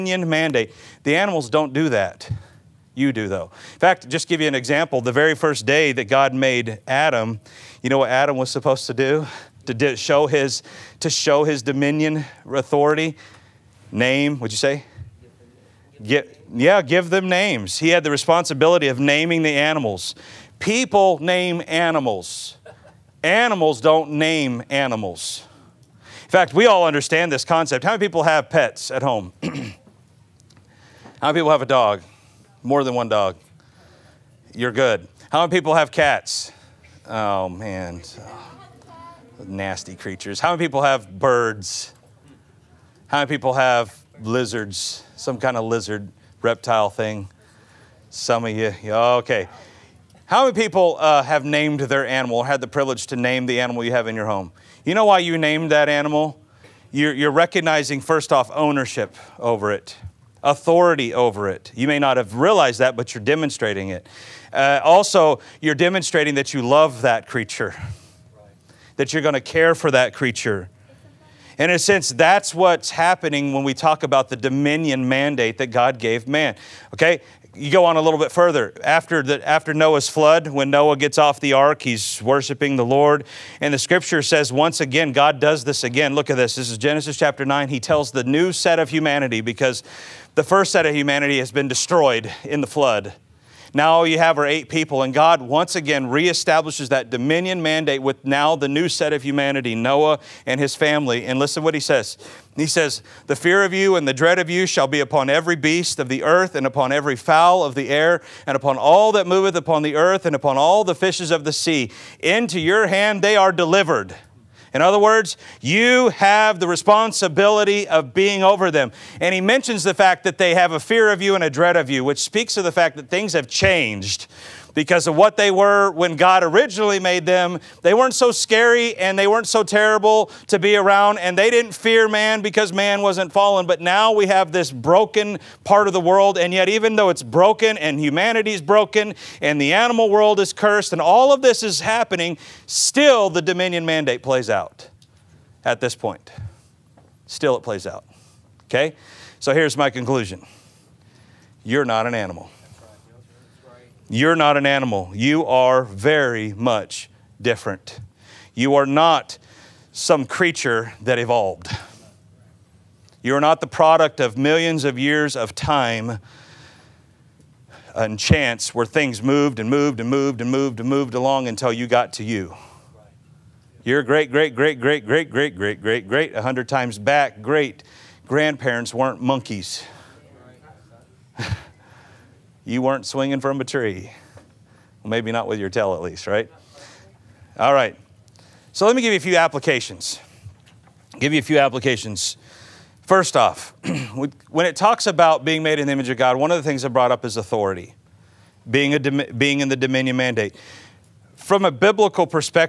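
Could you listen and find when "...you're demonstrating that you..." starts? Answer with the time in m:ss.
1:05.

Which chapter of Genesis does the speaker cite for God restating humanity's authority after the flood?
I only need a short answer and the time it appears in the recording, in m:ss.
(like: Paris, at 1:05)
Chapter 9, at 1:26.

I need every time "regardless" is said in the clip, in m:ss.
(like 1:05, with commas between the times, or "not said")
not said.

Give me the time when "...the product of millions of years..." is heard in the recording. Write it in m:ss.
2:43.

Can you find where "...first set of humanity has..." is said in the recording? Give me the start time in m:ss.
1:30.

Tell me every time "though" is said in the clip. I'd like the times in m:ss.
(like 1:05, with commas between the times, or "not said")
0:03, 2:16.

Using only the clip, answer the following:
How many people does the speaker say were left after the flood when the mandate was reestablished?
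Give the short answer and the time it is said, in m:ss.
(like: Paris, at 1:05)
8, at 1:34.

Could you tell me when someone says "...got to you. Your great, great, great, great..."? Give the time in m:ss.
2:51.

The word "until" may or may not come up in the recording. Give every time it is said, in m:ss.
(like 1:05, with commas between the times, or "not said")
2:51.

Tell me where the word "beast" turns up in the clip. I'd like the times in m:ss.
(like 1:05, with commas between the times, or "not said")
1:45.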